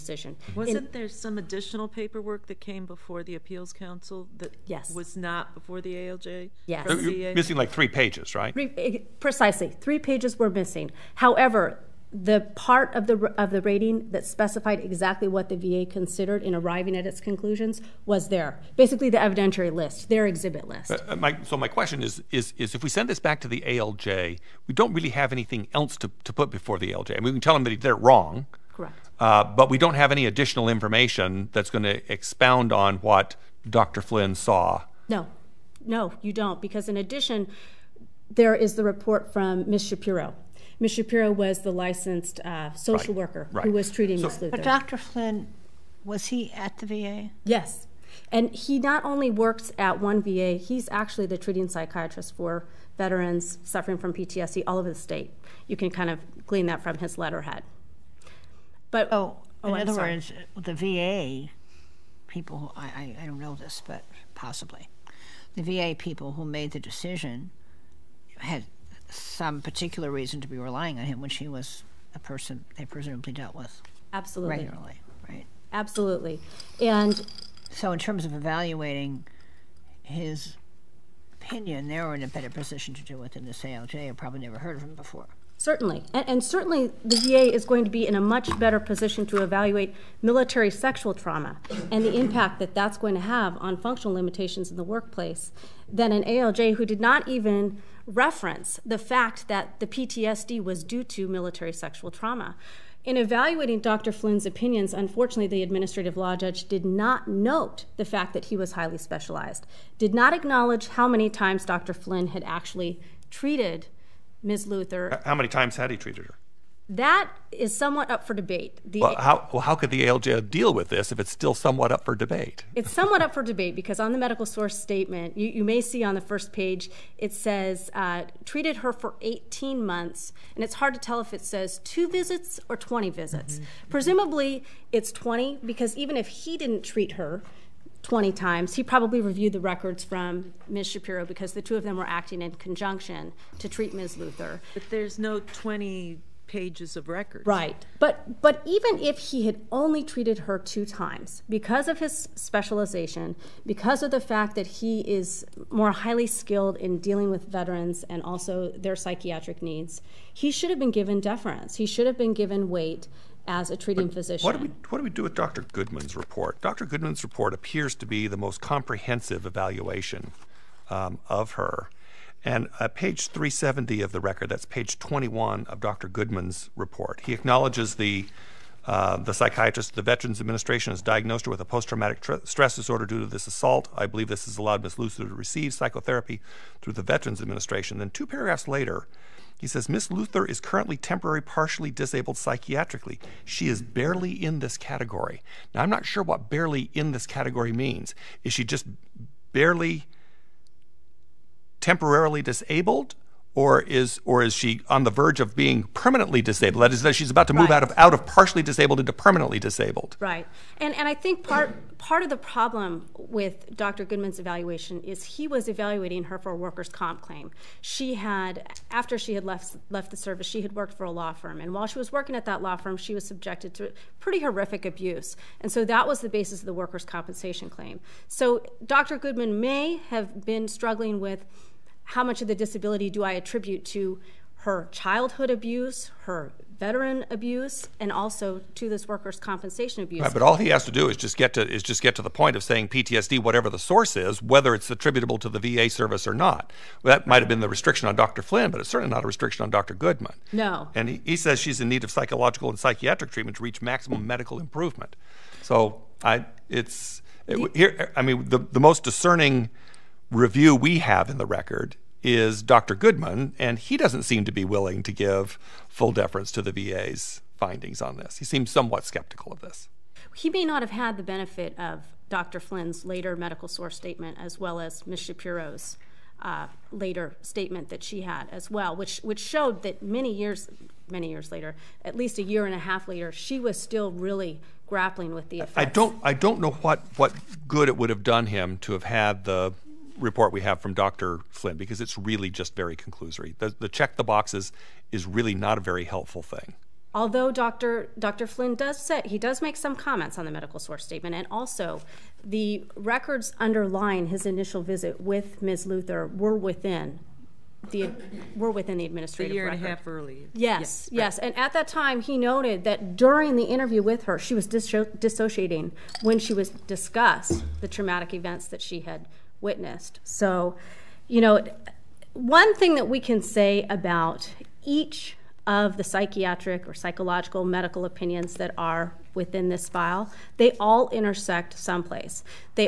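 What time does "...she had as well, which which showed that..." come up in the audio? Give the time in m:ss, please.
4:38.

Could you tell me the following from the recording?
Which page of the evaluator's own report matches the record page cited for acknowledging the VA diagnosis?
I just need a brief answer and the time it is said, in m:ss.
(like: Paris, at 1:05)
21, at 2:54.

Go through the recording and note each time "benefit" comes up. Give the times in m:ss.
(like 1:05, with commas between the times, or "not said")
4:31.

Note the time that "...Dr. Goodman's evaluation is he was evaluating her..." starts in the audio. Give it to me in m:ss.
3:33.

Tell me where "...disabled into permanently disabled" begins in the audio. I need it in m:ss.
3:28.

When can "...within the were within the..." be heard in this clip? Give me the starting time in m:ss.
5:06.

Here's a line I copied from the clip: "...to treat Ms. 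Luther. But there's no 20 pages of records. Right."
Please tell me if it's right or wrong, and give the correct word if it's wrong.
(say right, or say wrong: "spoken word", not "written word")
right.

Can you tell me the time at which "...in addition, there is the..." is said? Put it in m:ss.
0:36.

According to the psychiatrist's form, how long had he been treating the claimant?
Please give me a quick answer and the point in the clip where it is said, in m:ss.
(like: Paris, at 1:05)
18 months, at 2:09.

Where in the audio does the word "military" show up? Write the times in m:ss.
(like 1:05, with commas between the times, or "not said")
1:30, 1:41.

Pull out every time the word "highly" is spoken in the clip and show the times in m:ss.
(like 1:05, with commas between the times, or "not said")
1:48, 2:35.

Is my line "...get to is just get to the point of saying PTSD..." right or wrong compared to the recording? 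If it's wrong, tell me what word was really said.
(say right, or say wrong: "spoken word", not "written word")
right.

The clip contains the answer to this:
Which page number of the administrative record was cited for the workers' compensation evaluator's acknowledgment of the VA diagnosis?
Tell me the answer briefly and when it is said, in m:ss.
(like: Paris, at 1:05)
370, at 2:53.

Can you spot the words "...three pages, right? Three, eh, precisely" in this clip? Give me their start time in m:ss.
0:07.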